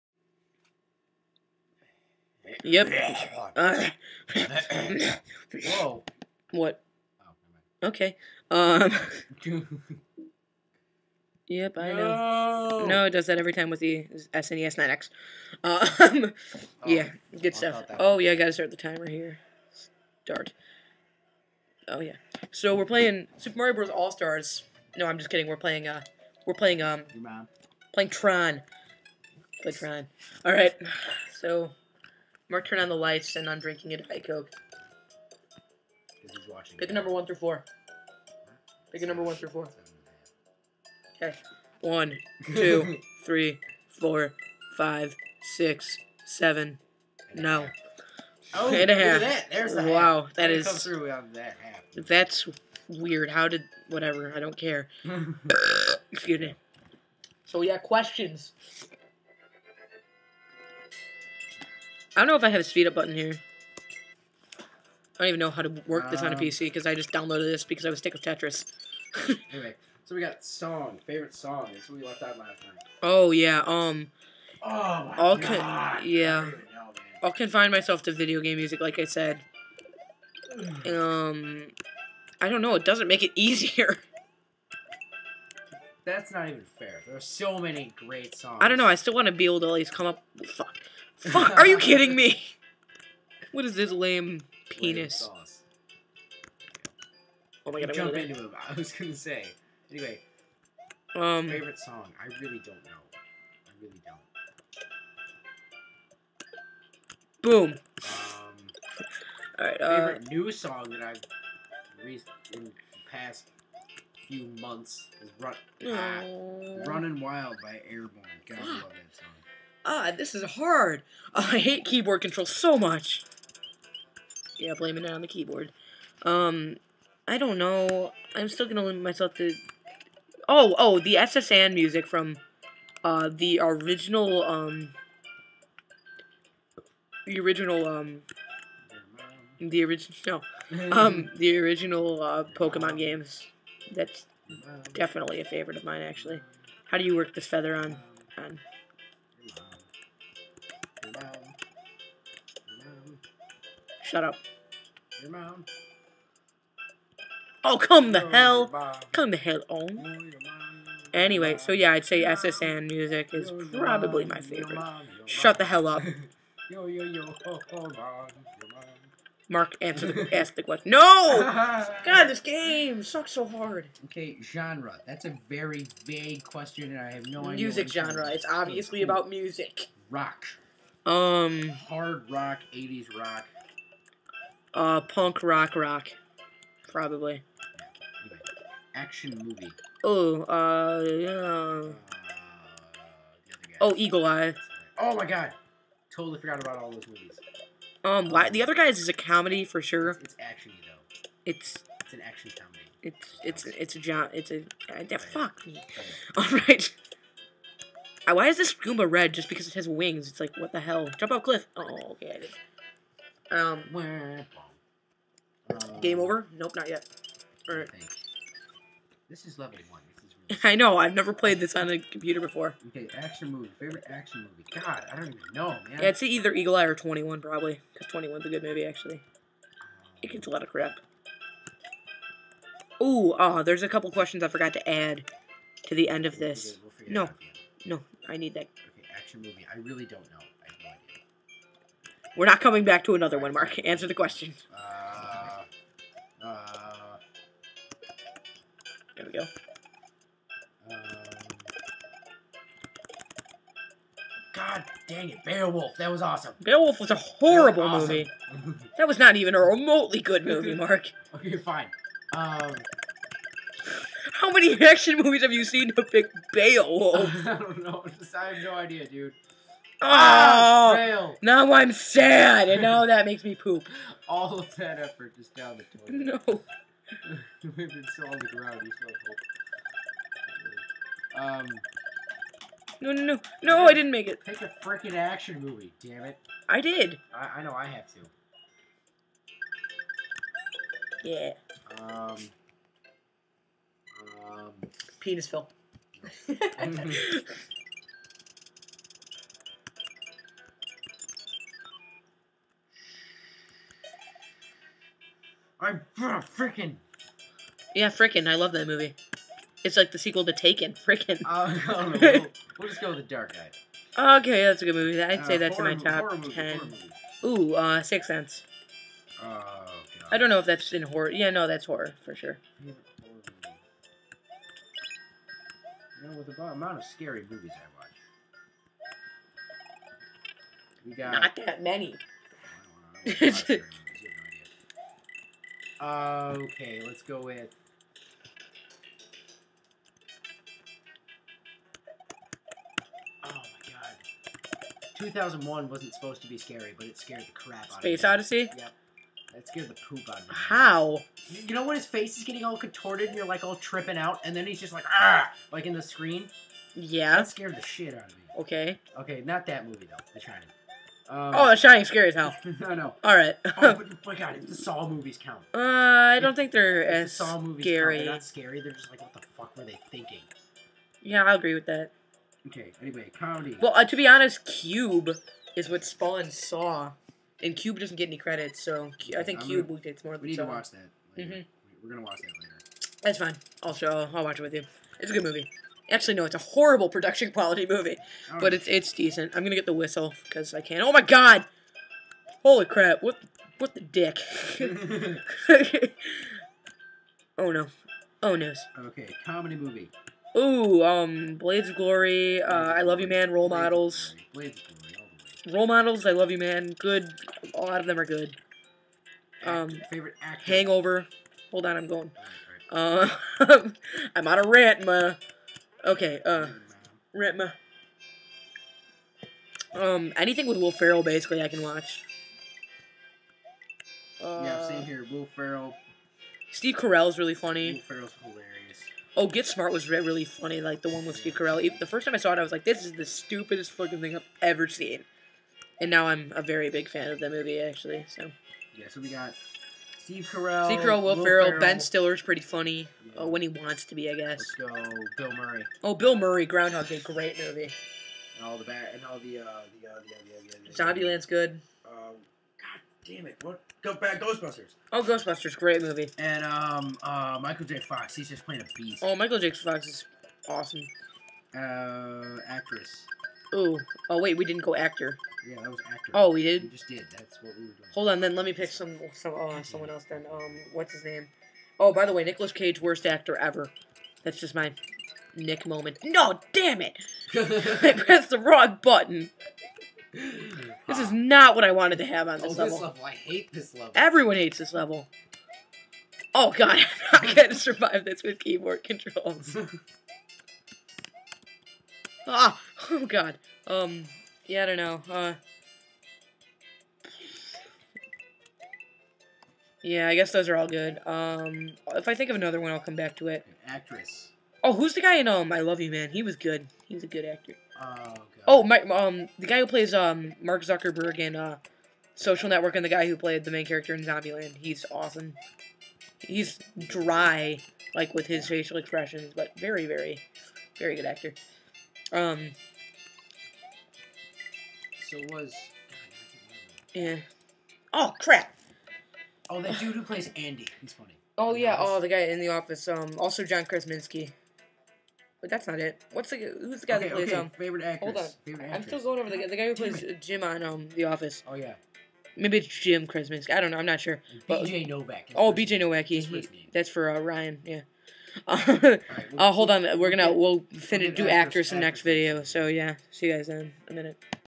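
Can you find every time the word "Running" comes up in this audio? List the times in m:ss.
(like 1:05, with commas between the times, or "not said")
1:56.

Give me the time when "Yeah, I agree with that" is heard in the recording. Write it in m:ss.
6:11.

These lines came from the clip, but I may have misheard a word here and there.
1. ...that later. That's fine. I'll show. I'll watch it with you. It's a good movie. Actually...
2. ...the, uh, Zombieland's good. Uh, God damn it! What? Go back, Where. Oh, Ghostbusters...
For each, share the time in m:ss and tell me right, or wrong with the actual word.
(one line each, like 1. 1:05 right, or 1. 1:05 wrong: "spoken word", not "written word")
1. 6:22 right
2. 7:31 wrong: "Ghostbusters", not "Where".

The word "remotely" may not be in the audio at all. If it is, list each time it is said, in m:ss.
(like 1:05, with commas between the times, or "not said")
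4:19.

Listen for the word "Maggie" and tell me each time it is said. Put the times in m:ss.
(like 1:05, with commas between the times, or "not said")
not said.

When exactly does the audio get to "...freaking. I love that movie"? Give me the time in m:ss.
5:08.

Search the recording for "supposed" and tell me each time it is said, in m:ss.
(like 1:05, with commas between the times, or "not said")
5:46.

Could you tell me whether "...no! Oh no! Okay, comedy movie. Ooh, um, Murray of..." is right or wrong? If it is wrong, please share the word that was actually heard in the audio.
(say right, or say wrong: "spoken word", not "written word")
wrong: "Blades", not "Murray".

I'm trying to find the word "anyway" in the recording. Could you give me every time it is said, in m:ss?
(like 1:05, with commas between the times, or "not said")
1:09, 1:39, 2:41, 6:13.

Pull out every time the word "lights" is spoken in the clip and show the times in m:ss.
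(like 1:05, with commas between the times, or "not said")
0:32.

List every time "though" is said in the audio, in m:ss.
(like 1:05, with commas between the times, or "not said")
3:20, 6:00.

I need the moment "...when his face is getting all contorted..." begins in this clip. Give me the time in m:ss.
5:51.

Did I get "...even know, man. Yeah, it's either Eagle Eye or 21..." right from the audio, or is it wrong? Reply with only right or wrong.
right.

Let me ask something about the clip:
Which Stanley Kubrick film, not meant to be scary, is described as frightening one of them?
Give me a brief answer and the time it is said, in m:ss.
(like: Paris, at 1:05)
2001, at 5:45.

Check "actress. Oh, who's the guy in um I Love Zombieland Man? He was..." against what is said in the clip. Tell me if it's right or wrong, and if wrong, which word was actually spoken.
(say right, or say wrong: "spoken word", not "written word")
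wrong: "You", not "Zombieland".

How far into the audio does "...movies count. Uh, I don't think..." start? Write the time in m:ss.
6:05.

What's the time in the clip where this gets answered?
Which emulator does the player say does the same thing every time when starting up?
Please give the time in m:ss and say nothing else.
0:14.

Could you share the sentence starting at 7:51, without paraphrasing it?
Oh, by the way, Nicolas Cage, worst actor ever.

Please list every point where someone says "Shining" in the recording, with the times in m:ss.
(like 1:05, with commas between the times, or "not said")
6:01.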